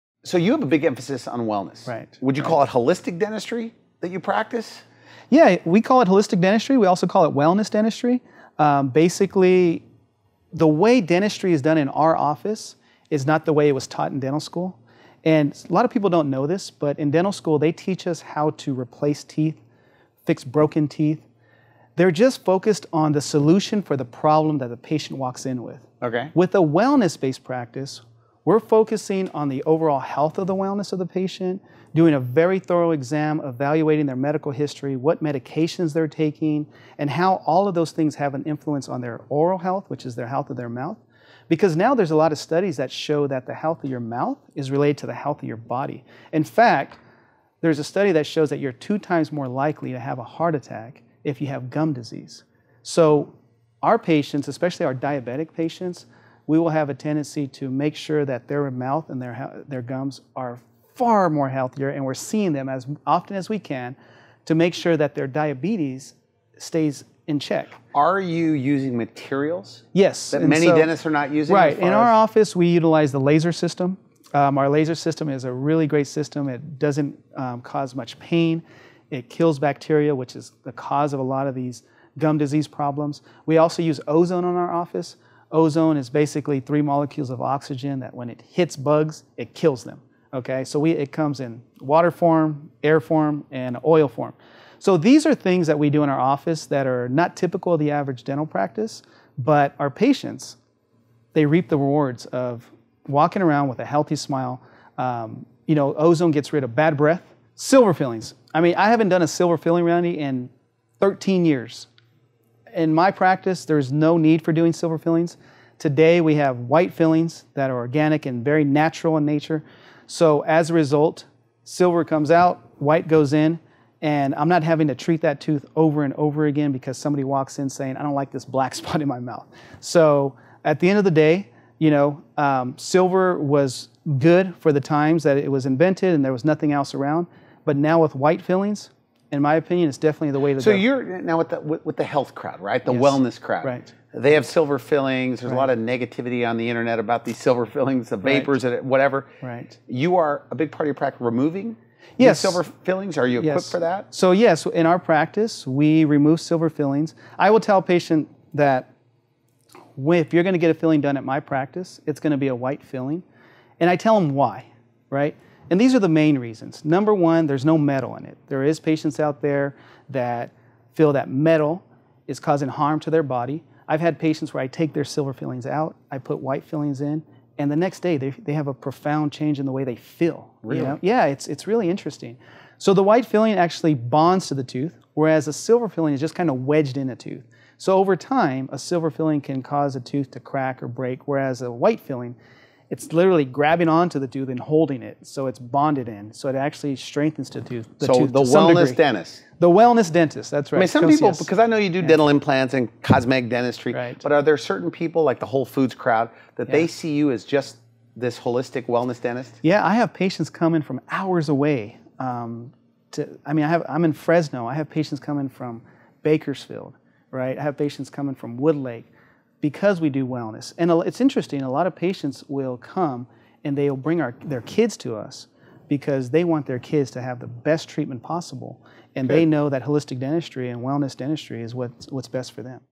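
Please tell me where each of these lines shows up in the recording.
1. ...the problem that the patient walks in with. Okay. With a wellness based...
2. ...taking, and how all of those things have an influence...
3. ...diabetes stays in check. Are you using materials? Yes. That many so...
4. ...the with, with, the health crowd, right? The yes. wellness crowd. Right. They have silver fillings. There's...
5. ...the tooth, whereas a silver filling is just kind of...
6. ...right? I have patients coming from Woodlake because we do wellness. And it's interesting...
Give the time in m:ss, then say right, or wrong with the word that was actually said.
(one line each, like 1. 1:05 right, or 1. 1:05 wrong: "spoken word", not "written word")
1. 0:23 right
2. 0:36 right
3. 1:05 right
4. 2:21 right
5. 3:04 right
6. 3:37 right.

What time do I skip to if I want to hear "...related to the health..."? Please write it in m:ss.
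0:44.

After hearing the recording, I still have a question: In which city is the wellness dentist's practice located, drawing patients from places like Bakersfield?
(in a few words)
Fresno.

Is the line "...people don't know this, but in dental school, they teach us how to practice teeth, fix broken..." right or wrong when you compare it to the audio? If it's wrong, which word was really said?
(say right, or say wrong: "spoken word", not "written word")
wrong: "replace", not "practice".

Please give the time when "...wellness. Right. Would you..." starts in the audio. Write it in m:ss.
0:01.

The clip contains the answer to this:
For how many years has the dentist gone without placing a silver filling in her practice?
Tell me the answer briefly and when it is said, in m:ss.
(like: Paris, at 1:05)
13, at 1:51.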